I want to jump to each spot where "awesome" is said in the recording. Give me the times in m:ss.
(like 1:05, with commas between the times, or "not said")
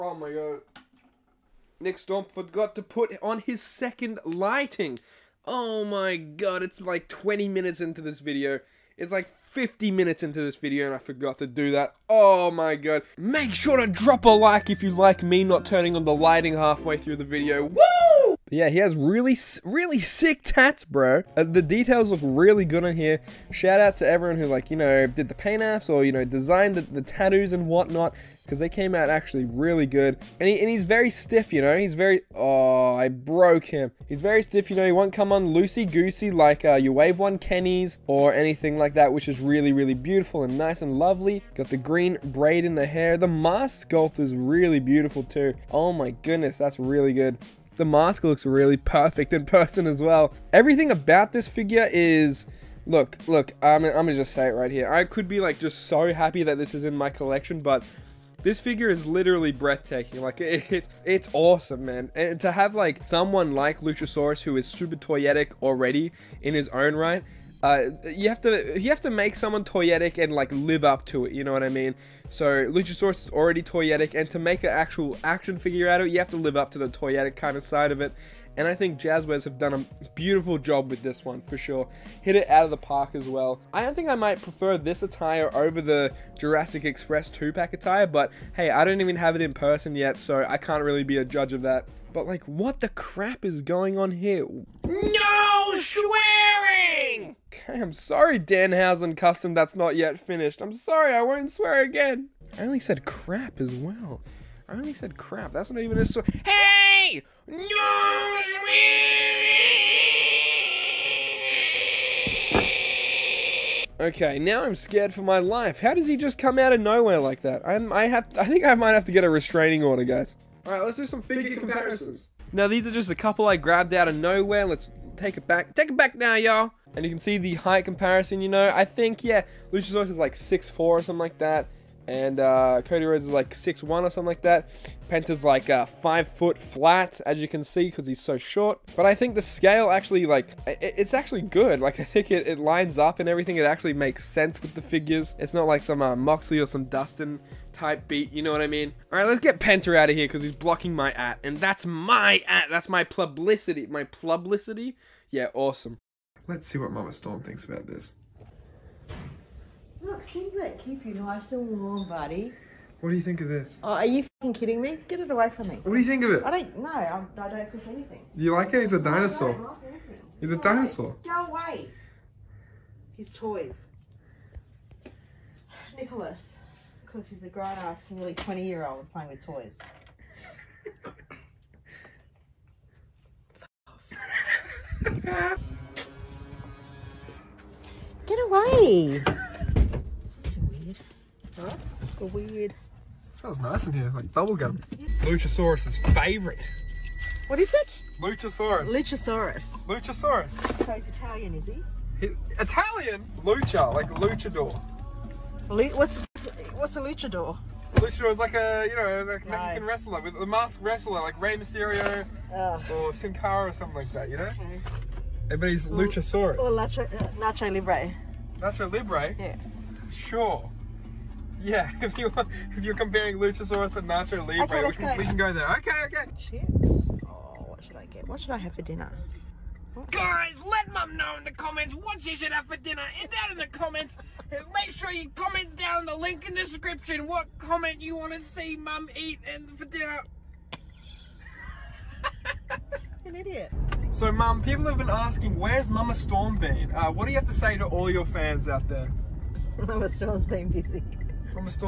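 1:01, 2:35.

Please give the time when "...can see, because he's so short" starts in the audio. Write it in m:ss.
2:17.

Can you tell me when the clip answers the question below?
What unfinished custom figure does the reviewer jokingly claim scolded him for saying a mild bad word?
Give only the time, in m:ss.
1:38.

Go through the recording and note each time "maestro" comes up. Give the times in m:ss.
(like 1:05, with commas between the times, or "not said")
not said.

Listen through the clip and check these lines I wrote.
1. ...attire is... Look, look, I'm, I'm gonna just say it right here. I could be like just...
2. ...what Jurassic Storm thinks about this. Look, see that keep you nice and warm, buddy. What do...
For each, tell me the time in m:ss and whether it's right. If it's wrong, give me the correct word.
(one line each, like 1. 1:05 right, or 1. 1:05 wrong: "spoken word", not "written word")
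1. 0:51 wrong: "figure", not "attire"
2. 2:36 wrong: "Mama", not "Jurassic".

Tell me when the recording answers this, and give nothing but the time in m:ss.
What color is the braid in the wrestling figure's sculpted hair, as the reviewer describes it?
0:41.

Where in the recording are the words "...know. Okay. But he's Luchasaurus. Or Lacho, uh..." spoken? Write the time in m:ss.
3:34.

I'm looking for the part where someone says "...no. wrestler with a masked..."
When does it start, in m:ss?
3:29.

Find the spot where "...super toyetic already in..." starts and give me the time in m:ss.
1:04.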